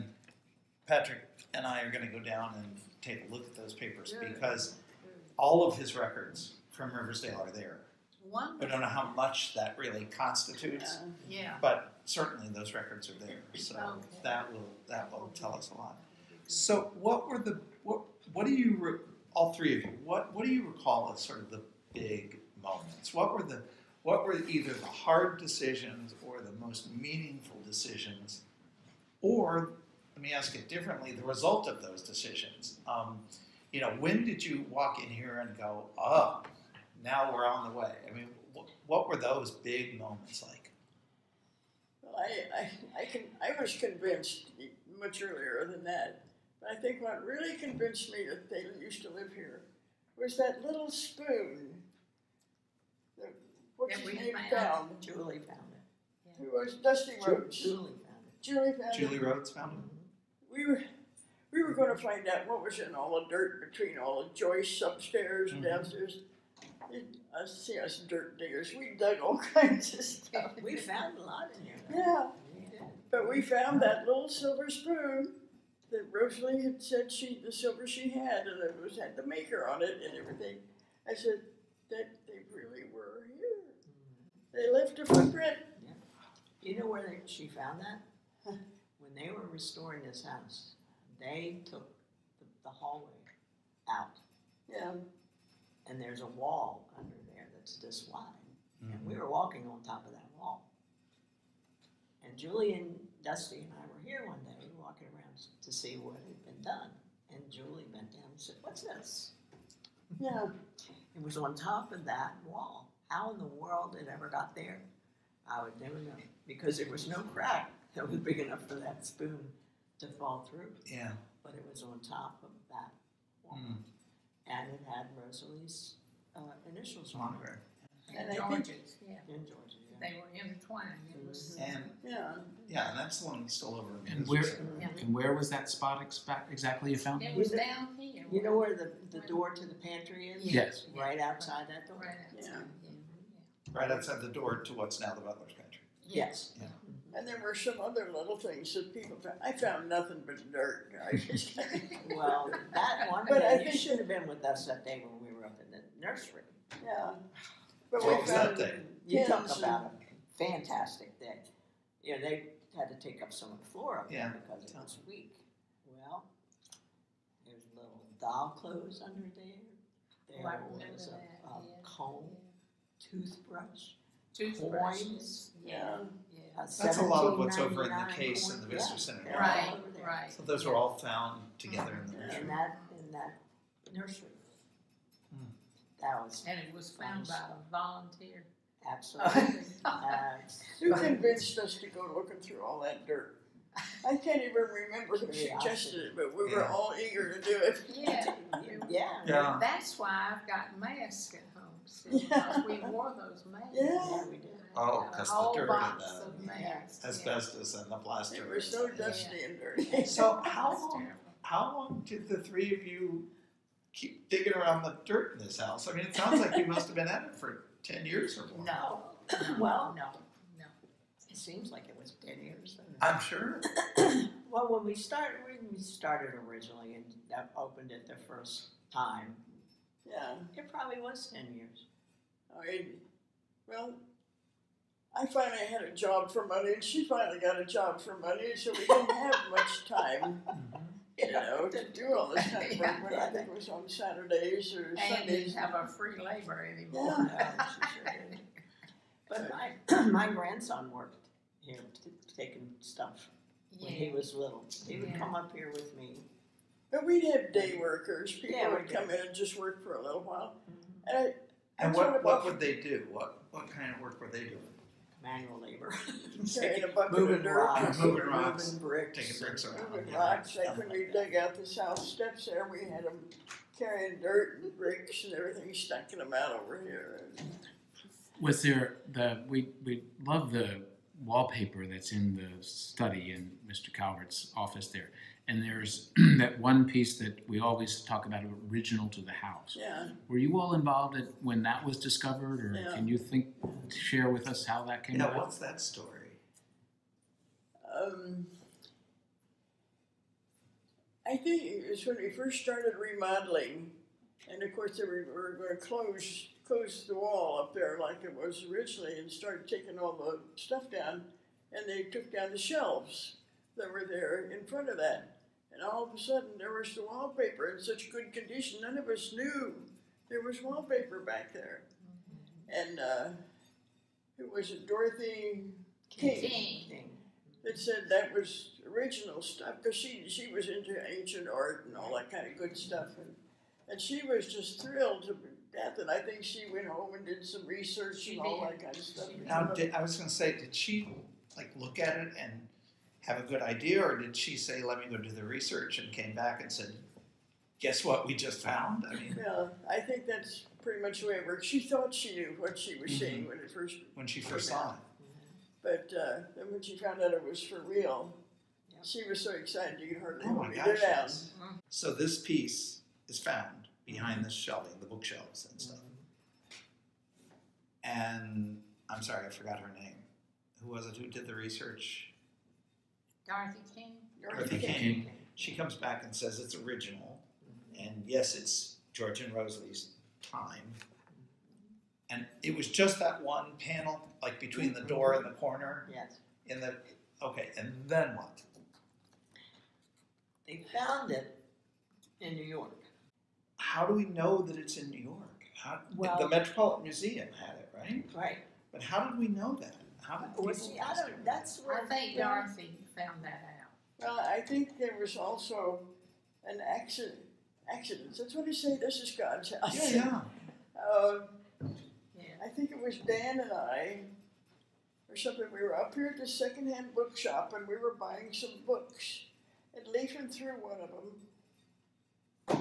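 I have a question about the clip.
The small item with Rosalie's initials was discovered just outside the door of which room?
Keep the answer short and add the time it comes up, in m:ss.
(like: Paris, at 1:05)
Butler's Pantry, at 2:25.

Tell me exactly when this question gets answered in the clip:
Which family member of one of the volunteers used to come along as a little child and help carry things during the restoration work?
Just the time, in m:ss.
4:10.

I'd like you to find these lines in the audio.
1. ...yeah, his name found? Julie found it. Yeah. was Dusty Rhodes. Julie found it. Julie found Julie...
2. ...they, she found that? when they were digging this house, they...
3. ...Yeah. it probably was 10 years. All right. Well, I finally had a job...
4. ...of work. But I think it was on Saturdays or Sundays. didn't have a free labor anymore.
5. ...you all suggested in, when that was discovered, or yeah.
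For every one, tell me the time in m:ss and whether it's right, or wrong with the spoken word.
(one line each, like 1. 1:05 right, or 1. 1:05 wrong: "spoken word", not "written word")
1. 0:53 right
2. 1:27 wrong: "restoring", not "digging"
3. 3:50 right
4. 4:02 right
5. 4:50 wrong: "involved", not "suggested".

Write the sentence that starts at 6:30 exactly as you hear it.
They found it in New York.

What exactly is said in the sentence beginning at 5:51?
She thought she knew what she was mm-hmm.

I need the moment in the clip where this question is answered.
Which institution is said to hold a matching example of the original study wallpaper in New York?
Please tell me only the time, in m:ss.
6:36.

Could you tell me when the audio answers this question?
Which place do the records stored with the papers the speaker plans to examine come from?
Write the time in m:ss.
0:06.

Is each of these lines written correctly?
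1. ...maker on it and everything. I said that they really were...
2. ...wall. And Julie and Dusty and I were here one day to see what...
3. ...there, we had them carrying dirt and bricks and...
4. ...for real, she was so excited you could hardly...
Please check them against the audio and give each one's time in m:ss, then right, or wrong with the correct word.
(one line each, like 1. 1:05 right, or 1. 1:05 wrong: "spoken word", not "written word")
1. 1:19 right
2. 1:40 right
3. 4:32 right
4. 5:57 right.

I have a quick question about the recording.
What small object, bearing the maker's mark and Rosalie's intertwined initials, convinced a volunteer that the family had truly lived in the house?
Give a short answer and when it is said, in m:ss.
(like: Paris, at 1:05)
silver spoon, at 1:14.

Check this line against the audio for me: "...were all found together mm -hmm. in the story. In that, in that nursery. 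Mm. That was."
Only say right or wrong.
wrong.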